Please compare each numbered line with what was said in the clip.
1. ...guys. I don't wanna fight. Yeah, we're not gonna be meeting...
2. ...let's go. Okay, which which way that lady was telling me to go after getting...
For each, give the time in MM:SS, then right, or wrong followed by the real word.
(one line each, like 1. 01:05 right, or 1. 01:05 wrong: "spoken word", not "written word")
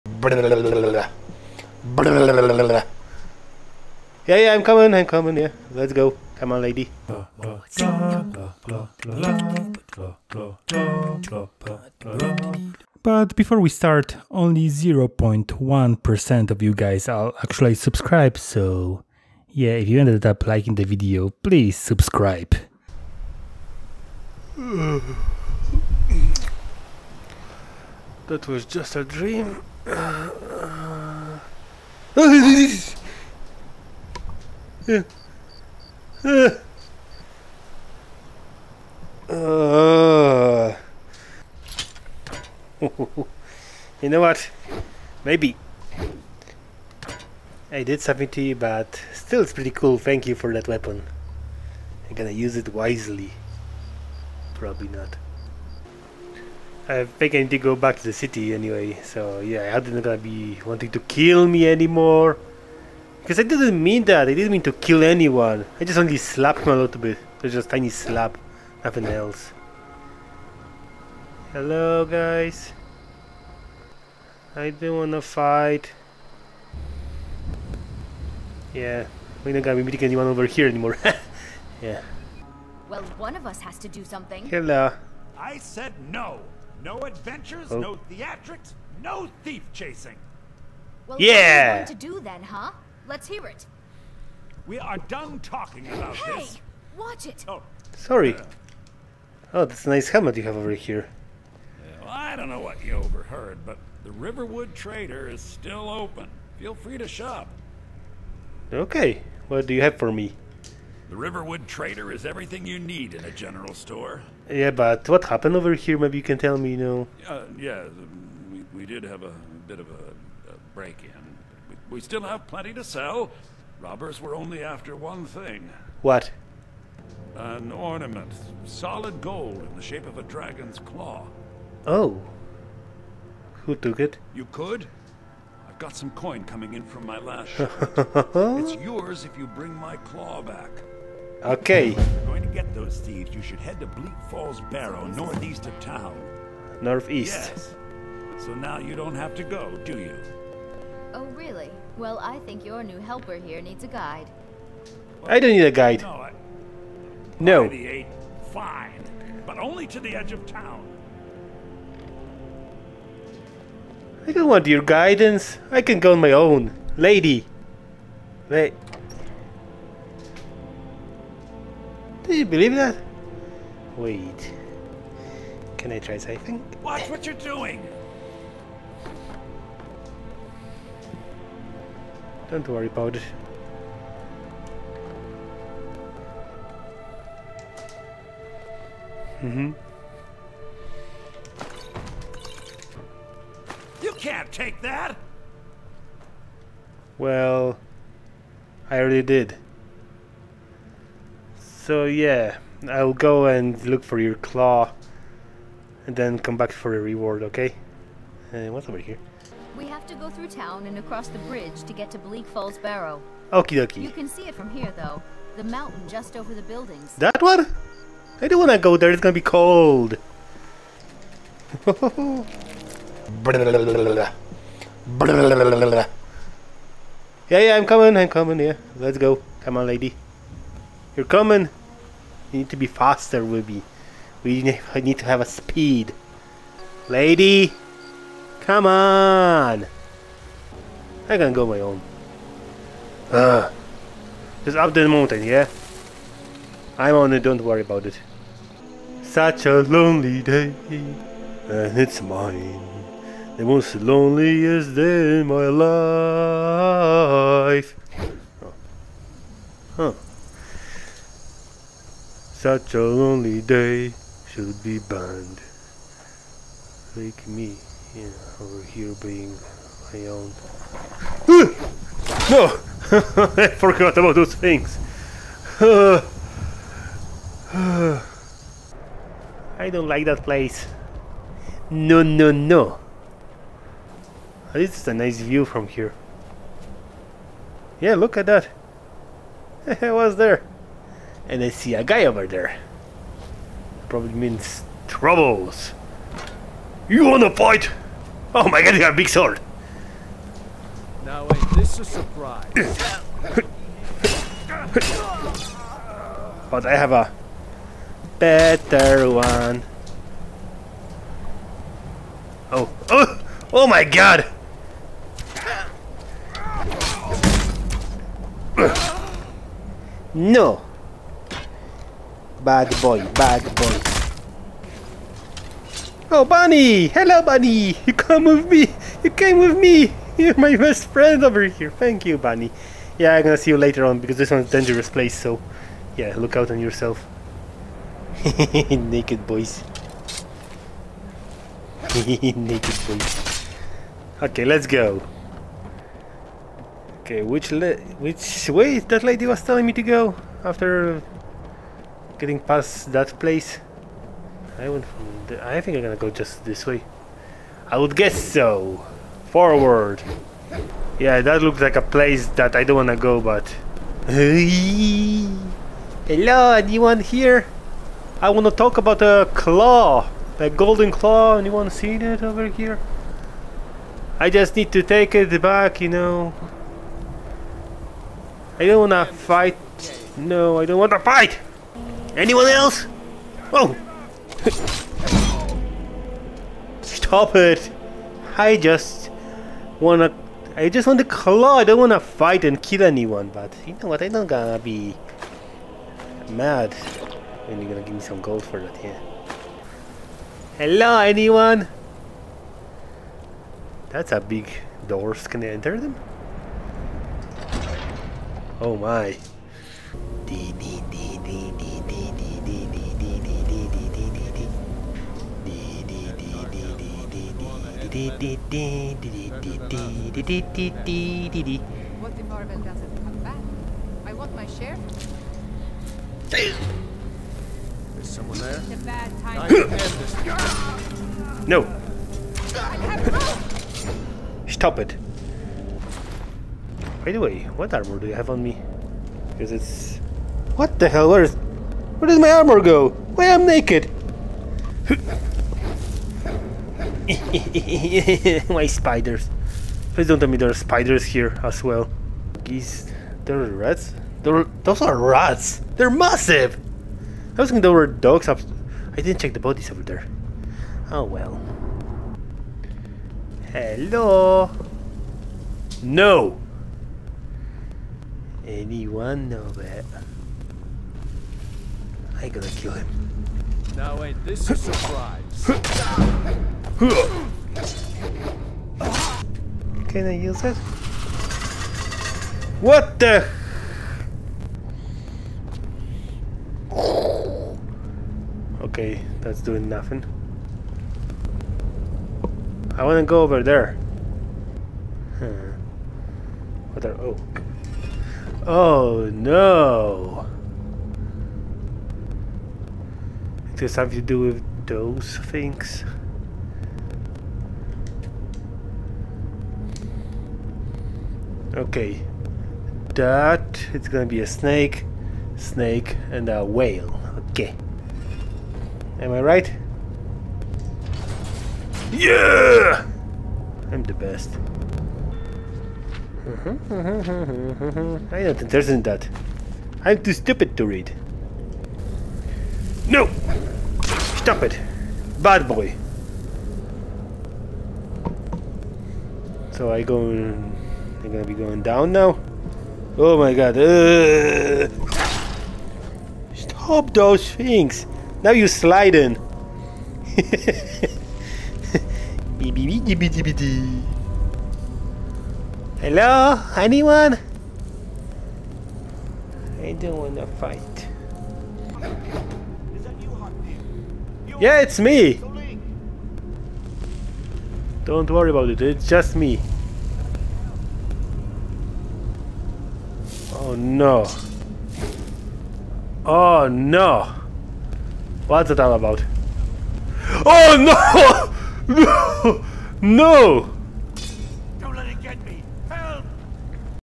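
1. 01:12 right
2. 05:44 right.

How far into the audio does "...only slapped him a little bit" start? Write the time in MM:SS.
01:05.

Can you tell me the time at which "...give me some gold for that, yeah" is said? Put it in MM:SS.
06:38.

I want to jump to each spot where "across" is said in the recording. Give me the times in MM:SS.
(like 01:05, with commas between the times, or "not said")
03:30.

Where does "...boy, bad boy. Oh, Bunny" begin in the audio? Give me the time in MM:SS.
05:23.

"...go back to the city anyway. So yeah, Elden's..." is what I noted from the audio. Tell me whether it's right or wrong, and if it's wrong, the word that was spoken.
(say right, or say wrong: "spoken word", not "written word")
right.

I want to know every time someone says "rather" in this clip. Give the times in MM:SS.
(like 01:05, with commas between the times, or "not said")
not said.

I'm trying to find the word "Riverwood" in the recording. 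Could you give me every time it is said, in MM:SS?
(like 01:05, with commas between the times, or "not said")
01:44, 01:51.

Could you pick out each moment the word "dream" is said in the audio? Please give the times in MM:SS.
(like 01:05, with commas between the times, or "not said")
00:29.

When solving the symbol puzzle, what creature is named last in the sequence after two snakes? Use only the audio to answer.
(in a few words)
Whale.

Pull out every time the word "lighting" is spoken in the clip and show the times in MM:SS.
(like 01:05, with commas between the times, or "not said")
not said.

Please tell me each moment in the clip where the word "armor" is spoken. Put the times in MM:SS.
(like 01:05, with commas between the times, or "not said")
07:17, 07:22.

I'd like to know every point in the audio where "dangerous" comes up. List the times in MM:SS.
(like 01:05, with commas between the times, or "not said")
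05:34.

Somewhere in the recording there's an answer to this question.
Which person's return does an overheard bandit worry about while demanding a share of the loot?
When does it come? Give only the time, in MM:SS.
06:58.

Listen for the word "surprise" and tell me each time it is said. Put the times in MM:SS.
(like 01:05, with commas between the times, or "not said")
05:02, 07:54.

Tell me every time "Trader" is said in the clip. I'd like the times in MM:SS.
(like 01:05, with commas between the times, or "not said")
01:44, 01:51.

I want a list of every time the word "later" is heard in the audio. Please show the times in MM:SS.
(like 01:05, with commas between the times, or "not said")
05:33.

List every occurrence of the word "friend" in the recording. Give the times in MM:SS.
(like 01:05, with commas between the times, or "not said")
05:31.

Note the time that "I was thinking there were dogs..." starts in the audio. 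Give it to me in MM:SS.
07:37.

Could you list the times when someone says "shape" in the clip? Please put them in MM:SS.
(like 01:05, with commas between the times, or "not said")
02:09.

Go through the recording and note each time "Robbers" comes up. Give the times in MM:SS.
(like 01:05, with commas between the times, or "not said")
02:03.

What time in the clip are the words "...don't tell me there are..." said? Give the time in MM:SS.
07:30.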